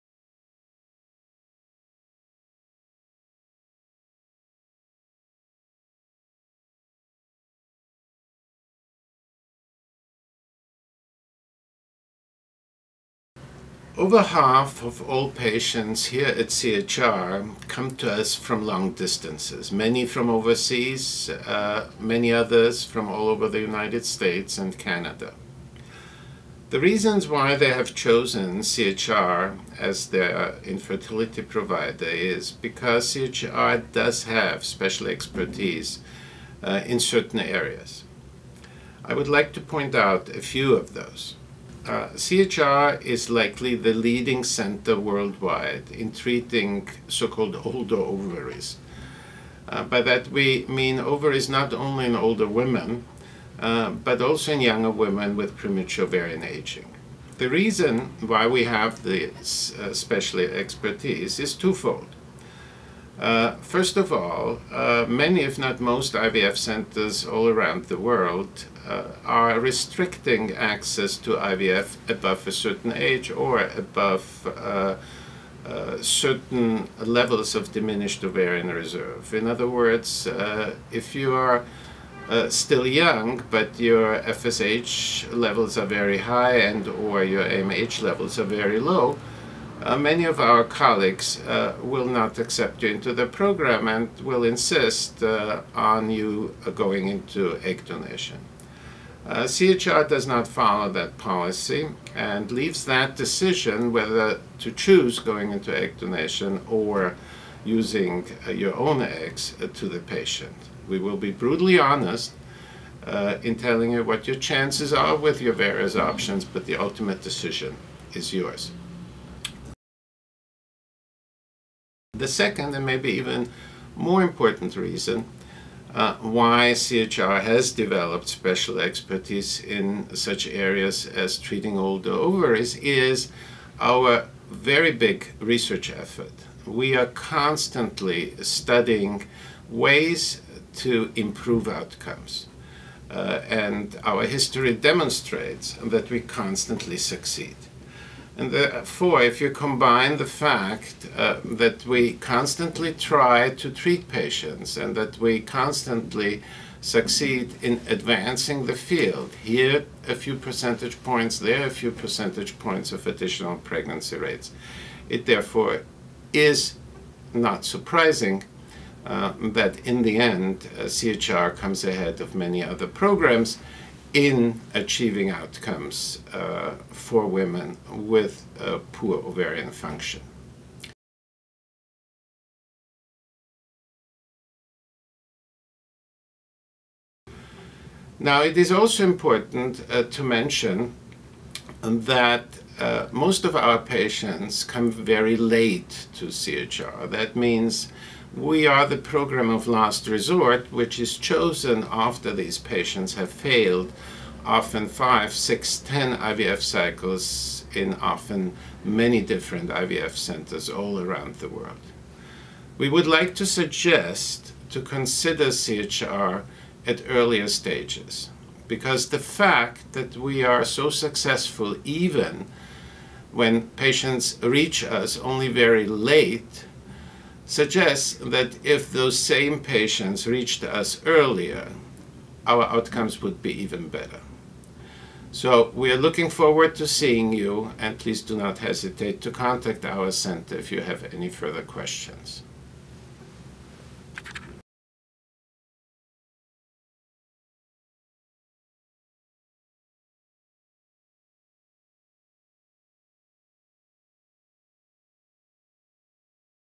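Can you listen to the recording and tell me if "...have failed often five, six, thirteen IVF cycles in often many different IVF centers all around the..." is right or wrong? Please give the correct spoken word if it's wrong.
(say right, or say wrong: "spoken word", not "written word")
wrong: "ten", not "thirteen".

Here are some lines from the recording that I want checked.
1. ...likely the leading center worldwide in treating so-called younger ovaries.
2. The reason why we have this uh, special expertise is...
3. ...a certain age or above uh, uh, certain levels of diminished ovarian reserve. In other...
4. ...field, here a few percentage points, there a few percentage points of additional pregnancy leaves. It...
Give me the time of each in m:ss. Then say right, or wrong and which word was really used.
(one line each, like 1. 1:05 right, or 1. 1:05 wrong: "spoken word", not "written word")
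1. 0:43 wrong: "older", not "younger"
2. 0:57 right
3. 1:12 right
4. 2:38 wrong: "rates", not "leaves".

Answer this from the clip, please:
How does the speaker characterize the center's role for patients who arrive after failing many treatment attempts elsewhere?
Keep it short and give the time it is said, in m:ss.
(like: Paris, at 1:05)
program of last resort, at 3:18.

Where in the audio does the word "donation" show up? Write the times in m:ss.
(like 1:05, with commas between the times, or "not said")
1:37, 1:45.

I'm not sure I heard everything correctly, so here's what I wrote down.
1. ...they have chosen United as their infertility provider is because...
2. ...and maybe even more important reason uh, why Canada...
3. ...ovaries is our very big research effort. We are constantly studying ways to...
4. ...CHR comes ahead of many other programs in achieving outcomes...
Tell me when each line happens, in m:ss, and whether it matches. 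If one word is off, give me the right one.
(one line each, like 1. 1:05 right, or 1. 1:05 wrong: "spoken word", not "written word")
1. 0:27 wrong: "CHR", not "United"
2. 2:02 wrong: "CHR", not "Canada"
3. 2:12 right
4. 2:50 right.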